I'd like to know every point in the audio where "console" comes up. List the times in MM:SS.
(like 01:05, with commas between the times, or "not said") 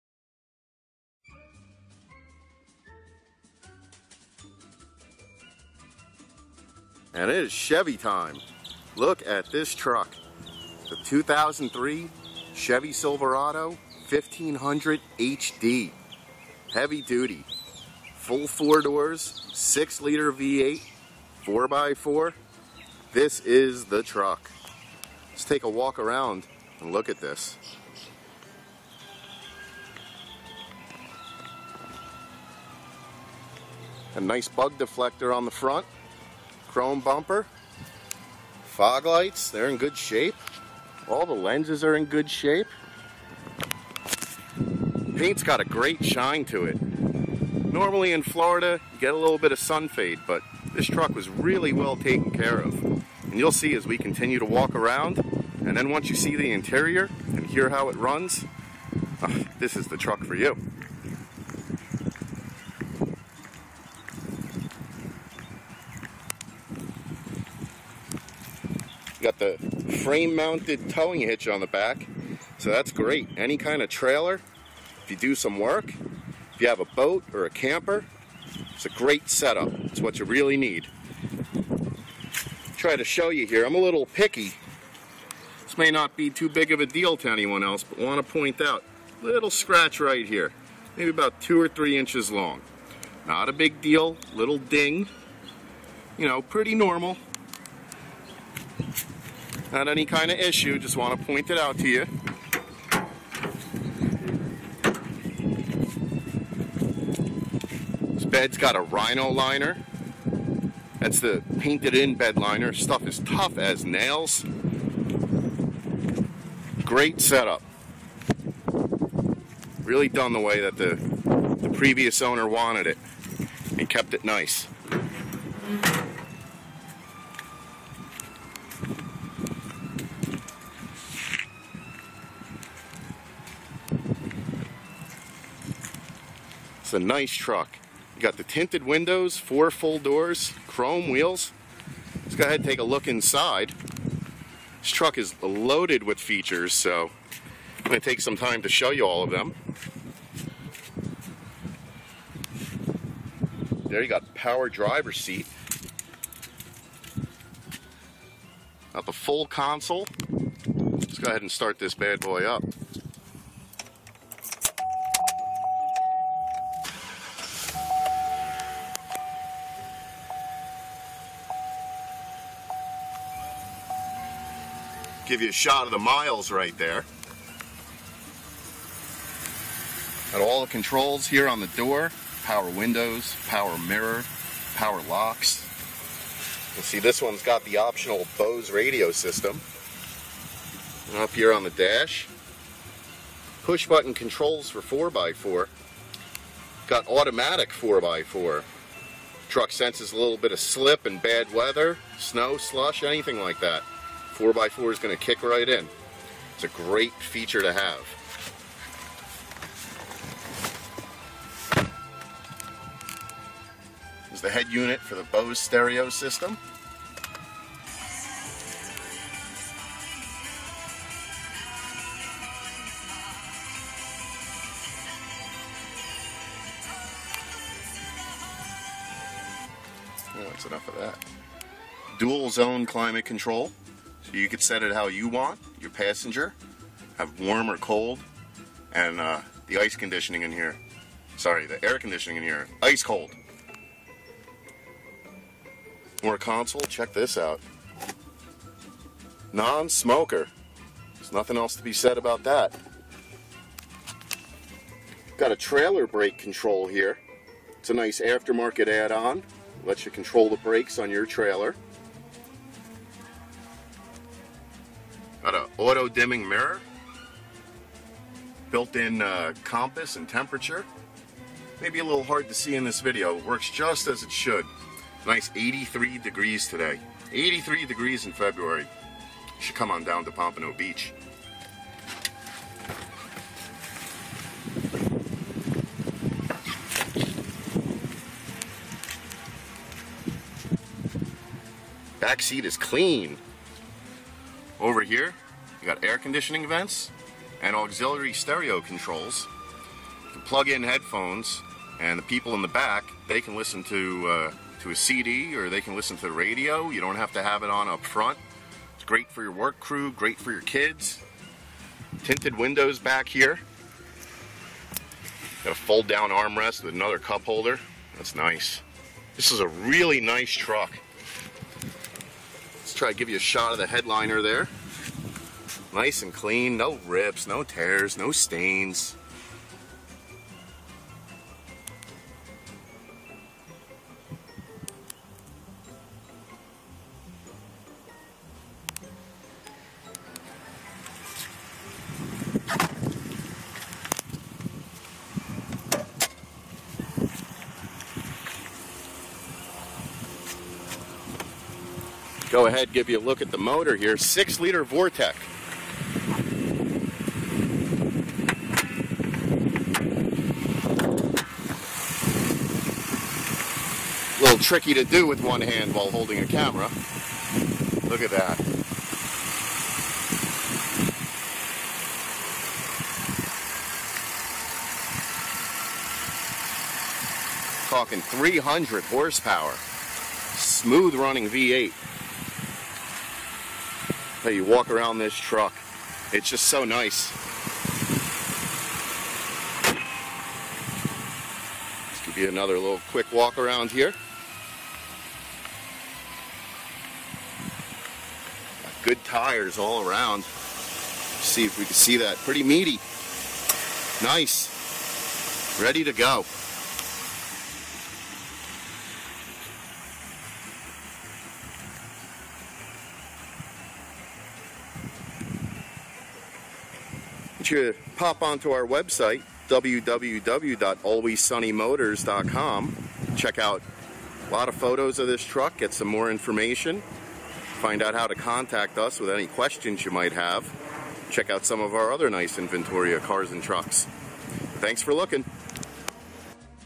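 02:39, 04:06.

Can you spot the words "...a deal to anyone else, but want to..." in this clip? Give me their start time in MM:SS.
01:26.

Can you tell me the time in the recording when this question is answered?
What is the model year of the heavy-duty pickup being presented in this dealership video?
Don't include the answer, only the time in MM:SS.
00:11.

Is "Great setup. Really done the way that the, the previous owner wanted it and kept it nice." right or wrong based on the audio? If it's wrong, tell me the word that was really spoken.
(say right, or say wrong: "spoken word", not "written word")
right.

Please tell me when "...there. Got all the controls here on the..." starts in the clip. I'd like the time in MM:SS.
02:56.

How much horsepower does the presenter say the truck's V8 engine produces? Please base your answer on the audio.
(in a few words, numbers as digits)
300.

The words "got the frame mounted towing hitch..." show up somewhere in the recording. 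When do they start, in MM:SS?
01:09.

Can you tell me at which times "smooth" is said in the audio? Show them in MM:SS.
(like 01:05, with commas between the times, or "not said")
06:20.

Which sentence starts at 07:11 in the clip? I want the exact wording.
Check out some of our other nice inventory of cars and trucks.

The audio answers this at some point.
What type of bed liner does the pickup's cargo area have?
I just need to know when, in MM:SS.
01:48.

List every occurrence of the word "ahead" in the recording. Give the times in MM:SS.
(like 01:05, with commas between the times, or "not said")
02:22, 02:41, 05:52.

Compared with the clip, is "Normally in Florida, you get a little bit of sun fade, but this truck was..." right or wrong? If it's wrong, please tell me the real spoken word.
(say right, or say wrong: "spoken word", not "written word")
right.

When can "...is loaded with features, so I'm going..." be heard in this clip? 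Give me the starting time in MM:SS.
02:25.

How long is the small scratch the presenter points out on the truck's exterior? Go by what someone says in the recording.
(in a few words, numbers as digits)
2 or 3 inches.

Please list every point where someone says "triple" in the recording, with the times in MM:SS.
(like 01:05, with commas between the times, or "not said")
not said.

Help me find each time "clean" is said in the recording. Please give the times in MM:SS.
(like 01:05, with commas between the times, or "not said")
04:52, 05:26.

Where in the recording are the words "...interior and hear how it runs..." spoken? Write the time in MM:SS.
00:56.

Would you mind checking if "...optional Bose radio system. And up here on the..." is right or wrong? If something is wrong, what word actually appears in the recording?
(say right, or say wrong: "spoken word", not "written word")
right.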